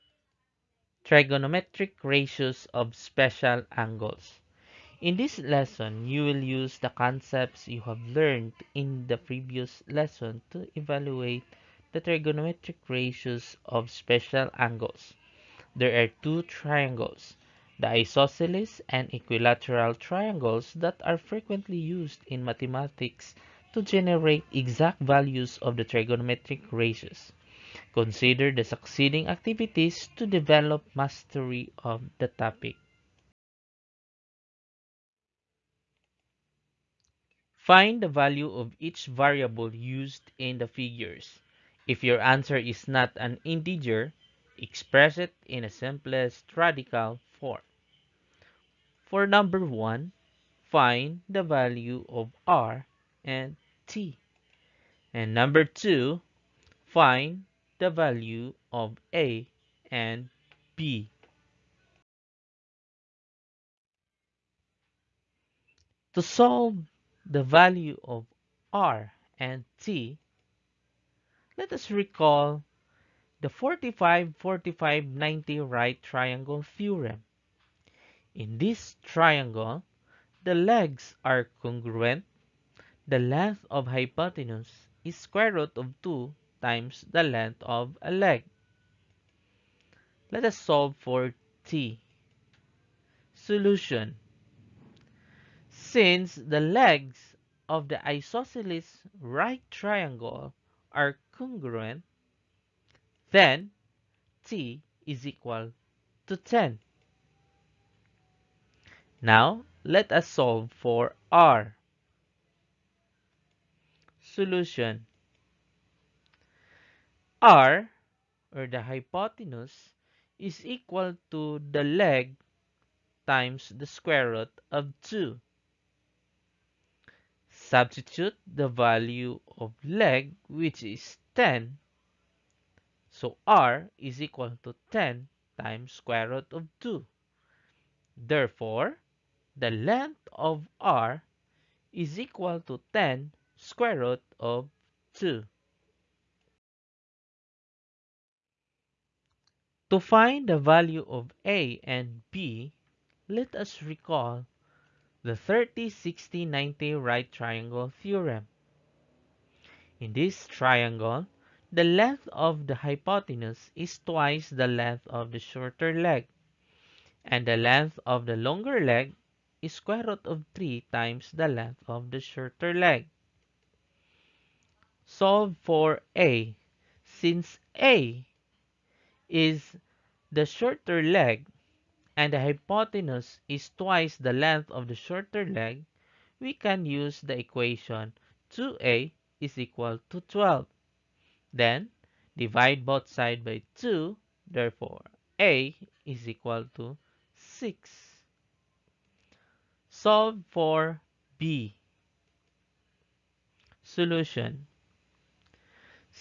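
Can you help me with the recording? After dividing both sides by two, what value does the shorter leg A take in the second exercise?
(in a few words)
6.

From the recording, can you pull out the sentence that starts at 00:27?
Consider the succeeding activities to develop mastery of the topic.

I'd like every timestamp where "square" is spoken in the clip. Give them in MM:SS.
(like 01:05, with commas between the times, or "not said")
01:25, 02:03, 02:15, 02:23, 02:49.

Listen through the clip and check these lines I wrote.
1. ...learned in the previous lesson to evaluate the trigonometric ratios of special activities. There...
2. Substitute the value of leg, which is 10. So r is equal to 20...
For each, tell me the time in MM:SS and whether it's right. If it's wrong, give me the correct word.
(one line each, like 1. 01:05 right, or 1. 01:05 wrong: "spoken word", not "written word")
1. 00:08 wrong: "angles", not "activities"
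2. 02:07 wrong: "10", not "20".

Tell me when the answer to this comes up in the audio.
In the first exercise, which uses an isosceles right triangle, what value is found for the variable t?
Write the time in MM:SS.
01:44.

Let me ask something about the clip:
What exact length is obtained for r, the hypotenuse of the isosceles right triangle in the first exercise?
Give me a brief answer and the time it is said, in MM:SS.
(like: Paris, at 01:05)
10√2, at 02:22.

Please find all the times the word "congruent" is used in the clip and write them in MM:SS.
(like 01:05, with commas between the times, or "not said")
01:21, 01:41.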